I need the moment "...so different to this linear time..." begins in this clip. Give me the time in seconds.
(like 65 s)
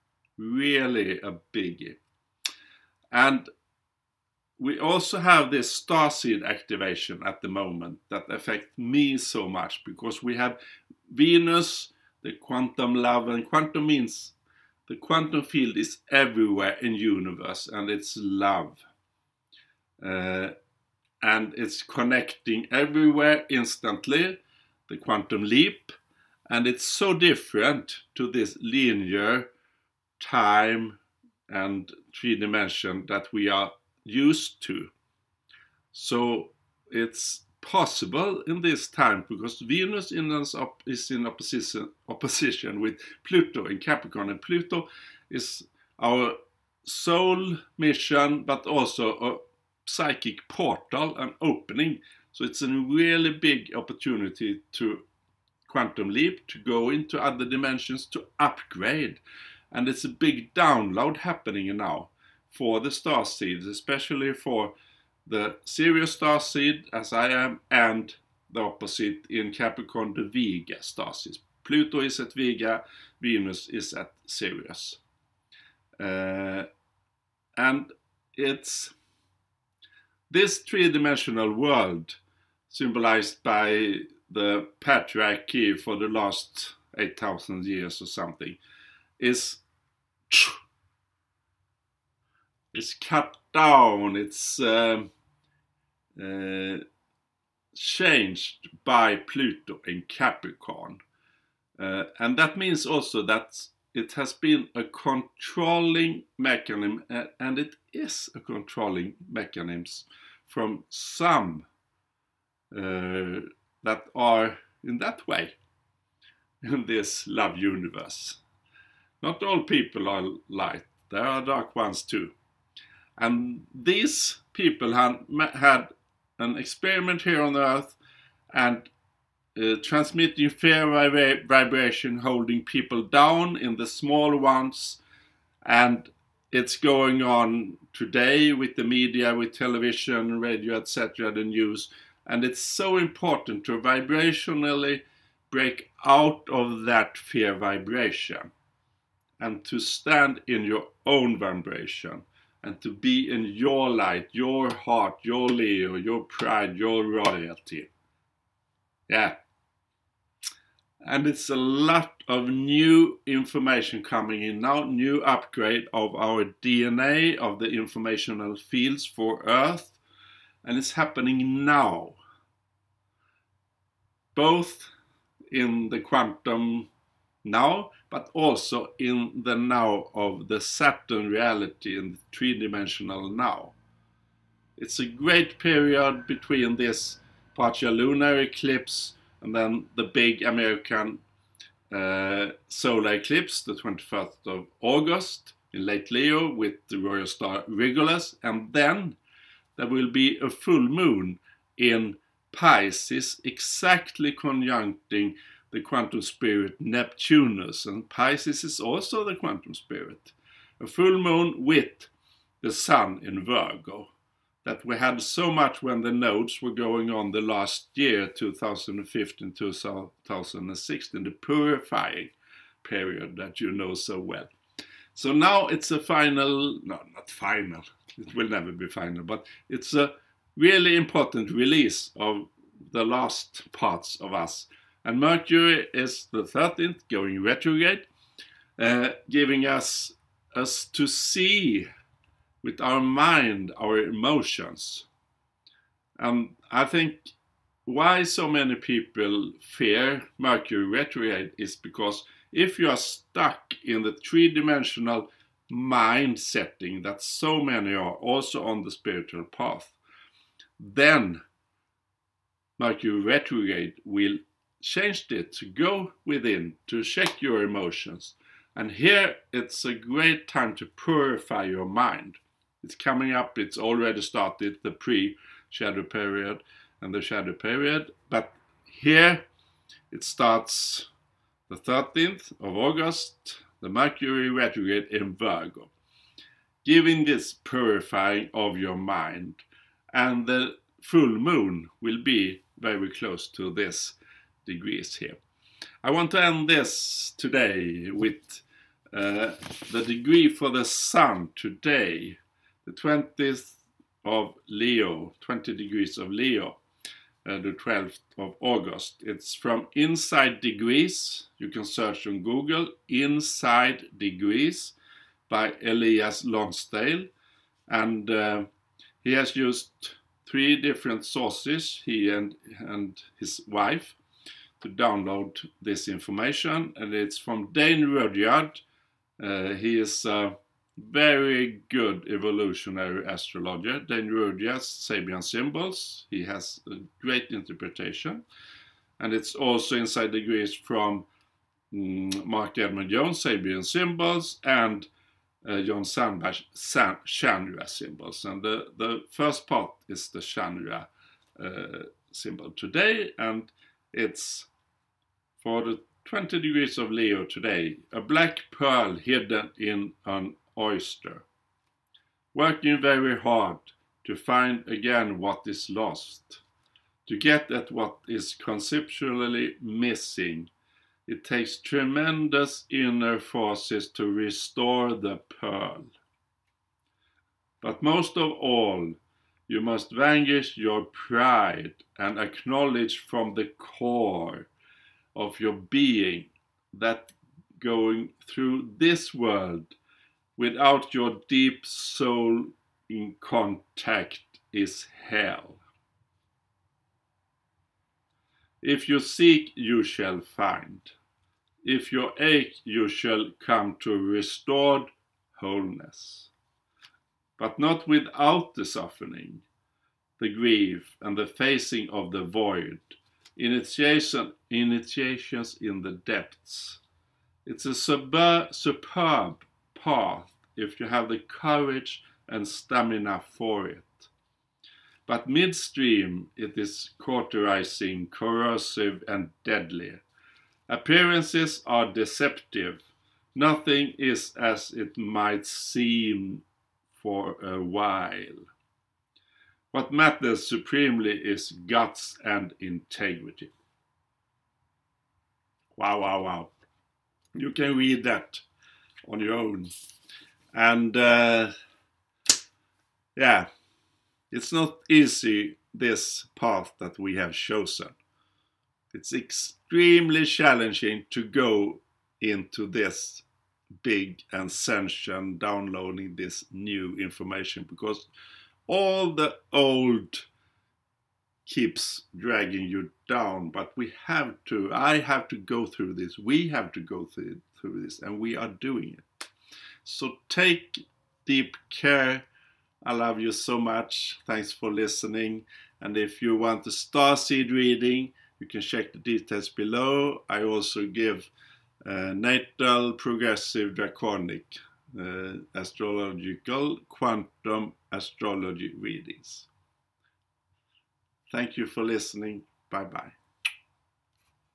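26 s.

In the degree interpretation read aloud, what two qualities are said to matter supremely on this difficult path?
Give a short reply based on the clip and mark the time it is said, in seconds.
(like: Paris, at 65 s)
Guts and integrity, at 441 s.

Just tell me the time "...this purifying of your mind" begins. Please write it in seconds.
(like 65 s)
287 s.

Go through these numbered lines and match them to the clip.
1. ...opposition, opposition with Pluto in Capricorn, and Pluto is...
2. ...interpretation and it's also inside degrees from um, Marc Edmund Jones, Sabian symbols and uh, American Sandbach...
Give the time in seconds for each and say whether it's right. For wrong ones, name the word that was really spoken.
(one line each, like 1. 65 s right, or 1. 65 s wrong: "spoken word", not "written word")
1. 41 s right
2. 337 s wrong: "John", not "American".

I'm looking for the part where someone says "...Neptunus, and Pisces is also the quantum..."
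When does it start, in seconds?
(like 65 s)
206 s.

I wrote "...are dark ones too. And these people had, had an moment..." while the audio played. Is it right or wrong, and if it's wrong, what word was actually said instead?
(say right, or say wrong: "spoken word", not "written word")
wrong: "experiment", not "moment".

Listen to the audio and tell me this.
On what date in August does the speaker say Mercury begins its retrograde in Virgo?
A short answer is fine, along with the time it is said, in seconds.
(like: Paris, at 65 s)
13th of August, at 281 s.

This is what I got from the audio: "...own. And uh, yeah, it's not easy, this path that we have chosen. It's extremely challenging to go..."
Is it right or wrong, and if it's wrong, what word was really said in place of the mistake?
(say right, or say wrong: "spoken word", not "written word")
right.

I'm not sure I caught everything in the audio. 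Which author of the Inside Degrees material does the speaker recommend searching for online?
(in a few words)
Elias Lonsdale.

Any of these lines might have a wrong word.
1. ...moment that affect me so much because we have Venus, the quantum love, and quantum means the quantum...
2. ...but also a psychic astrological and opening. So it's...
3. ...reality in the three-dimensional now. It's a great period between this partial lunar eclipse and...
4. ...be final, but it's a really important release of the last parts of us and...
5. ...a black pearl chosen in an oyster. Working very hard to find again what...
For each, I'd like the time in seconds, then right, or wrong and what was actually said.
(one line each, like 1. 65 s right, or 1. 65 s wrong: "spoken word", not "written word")
1. 7 s right
2. 48 s wrong: "portal", not "astrological"
3. 181 s right
4. 228 s right
5. 358 s wrong: "hidden", not "chosen".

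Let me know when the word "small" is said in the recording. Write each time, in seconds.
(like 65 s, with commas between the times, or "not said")
133 s.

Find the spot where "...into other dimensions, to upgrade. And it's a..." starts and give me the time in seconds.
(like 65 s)
56 s.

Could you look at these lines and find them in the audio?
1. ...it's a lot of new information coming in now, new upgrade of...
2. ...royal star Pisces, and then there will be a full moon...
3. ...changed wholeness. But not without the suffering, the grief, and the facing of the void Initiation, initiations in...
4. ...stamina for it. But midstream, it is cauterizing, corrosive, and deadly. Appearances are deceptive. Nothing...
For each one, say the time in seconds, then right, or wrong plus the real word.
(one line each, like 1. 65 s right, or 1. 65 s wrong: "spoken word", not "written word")
1. 161 s right
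2. 196 s wrong: "Regulus", not "Pisces"
3. 404 s wrong: "restored", not "changed"
4. 422 s right.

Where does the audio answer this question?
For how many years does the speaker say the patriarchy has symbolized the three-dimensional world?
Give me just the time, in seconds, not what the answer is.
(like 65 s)
86 s.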